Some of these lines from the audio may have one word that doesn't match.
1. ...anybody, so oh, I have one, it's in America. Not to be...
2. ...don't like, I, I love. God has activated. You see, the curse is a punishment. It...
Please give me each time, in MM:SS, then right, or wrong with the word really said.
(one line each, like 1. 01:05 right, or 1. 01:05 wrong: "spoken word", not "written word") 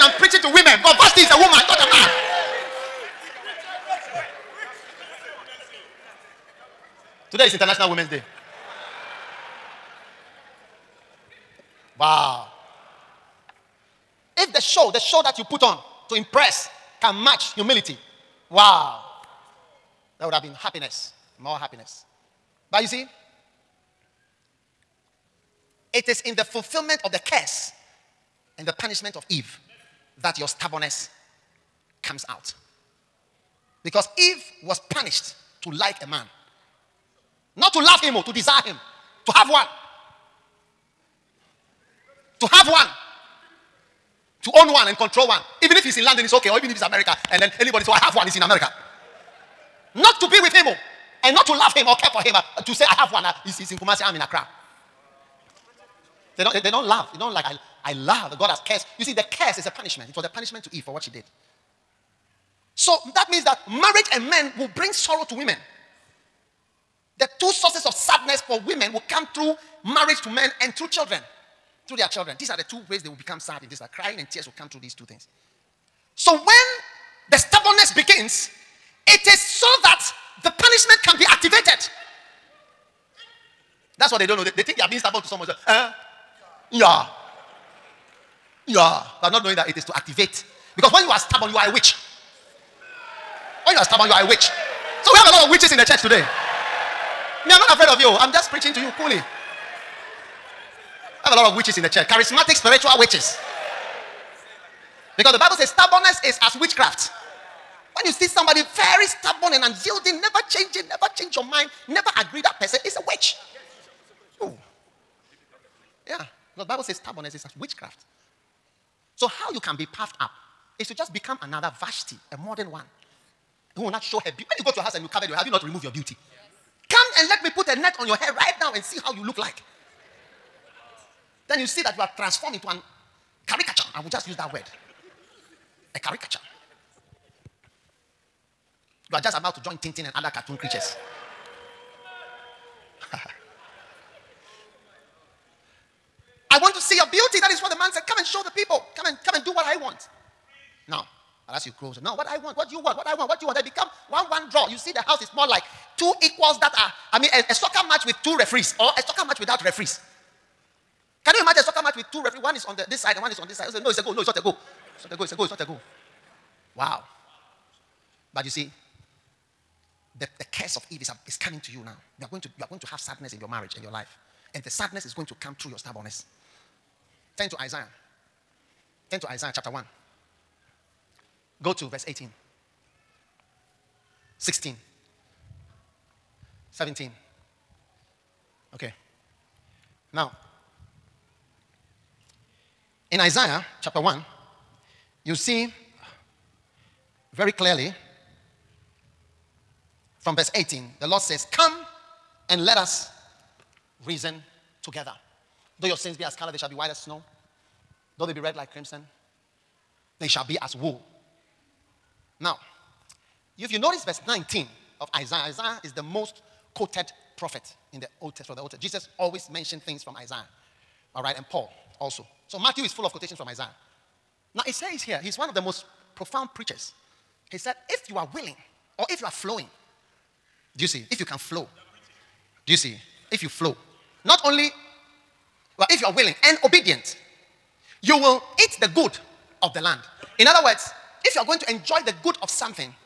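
1. 00:47 right
2. 00:57 wrong: "cursed", not "activated".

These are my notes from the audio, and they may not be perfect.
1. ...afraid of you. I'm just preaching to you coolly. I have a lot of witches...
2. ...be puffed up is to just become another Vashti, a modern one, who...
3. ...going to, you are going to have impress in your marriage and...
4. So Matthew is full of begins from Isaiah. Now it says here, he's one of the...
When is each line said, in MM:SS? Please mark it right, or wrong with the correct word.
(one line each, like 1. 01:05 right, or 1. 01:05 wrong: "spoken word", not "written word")
1. 01:37 right
2. 01:59 right
3. 02:52 wrong: "sadness", not "impress"
4. 03:42 wrong: "quotations", not "begins".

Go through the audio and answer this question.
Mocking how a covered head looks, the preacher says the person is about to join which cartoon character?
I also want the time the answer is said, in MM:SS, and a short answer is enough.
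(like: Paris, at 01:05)
Tintin, at 02:19.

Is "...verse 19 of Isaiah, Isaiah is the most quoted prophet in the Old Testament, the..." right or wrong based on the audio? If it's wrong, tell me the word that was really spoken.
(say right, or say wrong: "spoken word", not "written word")
right.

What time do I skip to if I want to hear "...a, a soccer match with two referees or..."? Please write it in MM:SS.
02:37.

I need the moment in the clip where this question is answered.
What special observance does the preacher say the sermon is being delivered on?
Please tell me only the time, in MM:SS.
00:07.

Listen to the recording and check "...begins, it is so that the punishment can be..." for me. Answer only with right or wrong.
right.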